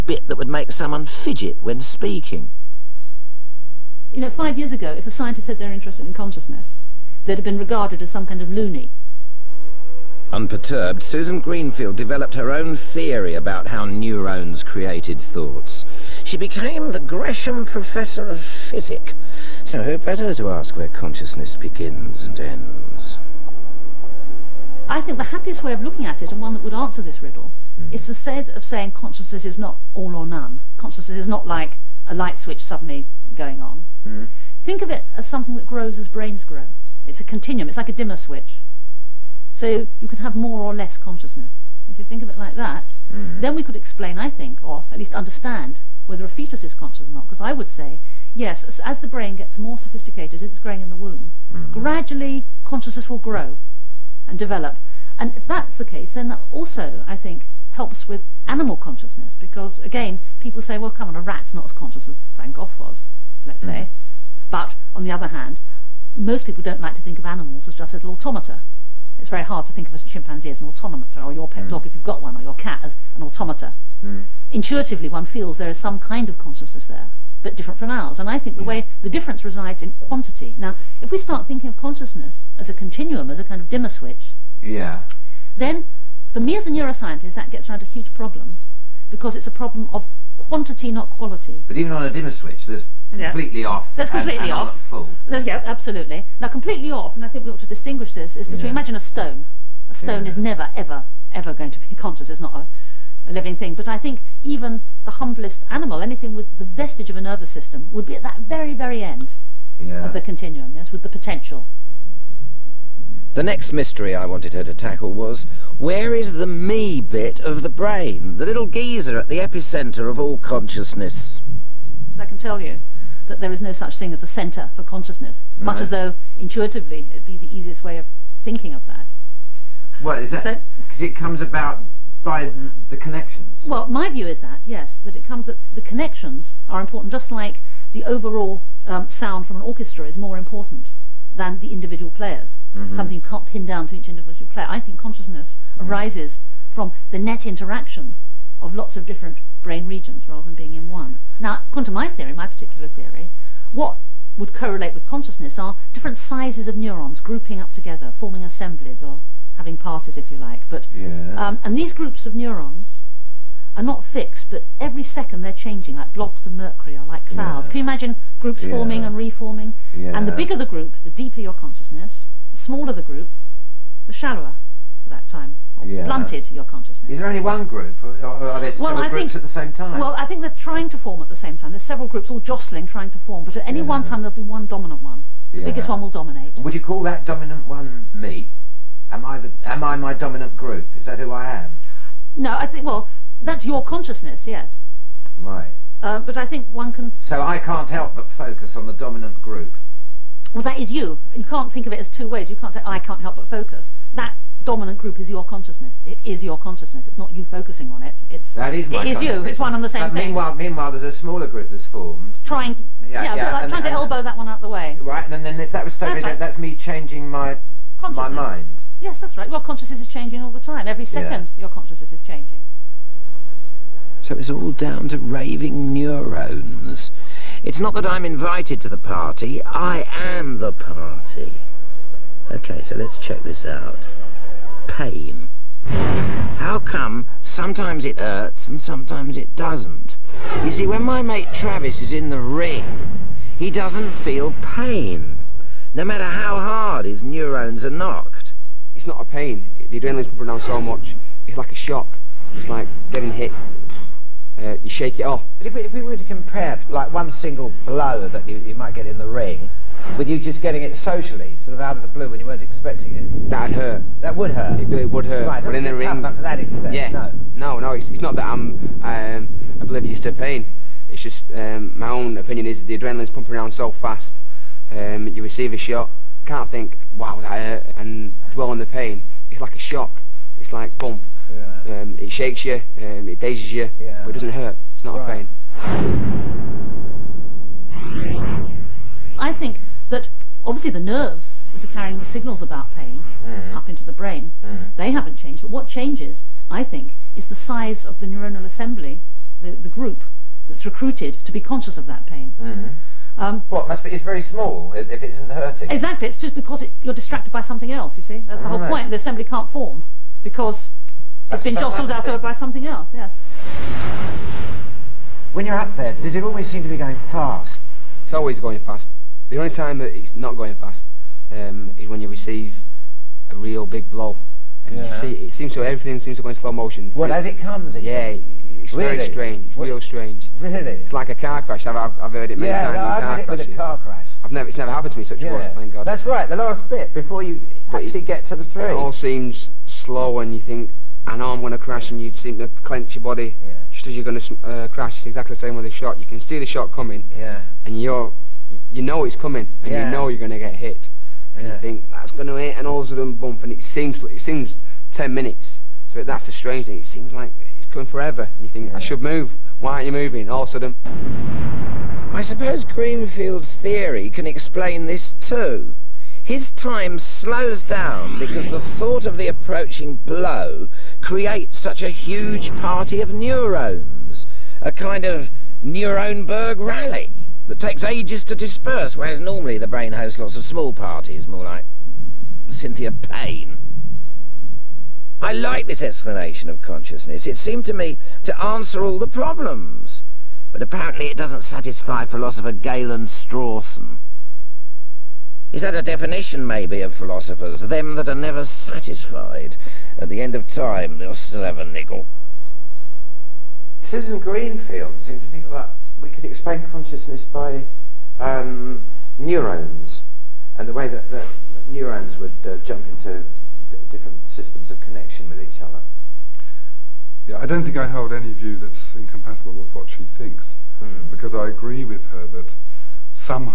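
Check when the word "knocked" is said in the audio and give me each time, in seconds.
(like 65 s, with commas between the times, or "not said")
248 s.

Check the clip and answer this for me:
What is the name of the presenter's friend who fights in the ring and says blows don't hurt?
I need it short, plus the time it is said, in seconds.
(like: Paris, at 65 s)
Travis, at 241 s.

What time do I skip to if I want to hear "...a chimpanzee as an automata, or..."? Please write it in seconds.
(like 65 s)
69 s.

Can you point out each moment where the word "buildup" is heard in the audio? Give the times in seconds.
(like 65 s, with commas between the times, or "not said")
not said.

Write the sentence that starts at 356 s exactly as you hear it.
It seems like it's coming forever.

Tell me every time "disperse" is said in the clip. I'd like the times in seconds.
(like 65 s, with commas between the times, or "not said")
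378 s.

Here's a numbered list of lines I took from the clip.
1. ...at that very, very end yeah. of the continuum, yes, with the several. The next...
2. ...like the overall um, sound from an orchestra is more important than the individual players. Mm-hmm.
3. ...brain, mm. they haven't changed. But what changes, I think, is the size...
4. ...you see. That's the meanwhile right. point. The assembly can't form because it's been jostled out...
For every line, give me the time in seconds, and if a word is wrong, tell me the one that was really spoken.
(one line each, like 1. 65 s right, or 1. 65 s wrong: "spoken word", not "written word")
1. 108 s wrong: "potential", not "several"
2. 137 s right
3. 294 s right
4. 308 s wrong: "whole", not "meanwhile".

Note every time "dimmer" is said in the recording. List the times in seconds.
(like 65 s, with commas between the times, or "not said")
38 s, 83 s, 92 s.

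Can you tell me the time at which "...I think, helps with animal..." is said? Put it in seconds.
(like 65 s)
57 s.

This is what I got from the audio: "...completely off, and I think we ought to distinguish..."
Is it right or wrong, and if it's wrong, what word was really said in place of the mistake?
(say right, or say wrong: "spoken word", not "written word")
right.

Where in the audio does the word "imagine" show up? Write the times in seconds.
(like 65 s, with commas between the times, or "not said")
98 s, 167 s.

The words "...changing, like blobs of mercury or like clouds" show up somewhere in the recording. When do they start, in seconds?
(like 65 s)
165 s.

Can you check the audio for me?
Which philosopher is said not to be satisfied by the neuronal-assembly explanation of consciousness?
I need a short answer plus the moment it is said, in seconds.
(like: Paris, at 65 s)
Galen Strawson, at 392 s.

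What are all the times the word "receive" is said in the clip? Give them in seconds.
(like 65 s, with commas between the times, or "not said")
275 s, 322 s.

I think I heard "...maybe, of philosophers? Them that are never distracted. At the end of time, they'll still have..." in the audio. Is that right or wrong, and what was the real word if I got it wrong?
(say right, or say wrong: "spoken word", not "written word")
wrong: "satisfied", not "distracted".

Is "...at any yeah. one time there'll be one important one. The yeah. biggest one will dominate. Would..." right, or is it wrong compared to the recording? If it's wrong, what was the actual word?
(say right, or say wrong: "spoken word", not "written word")
wrong: "dominant", not "important".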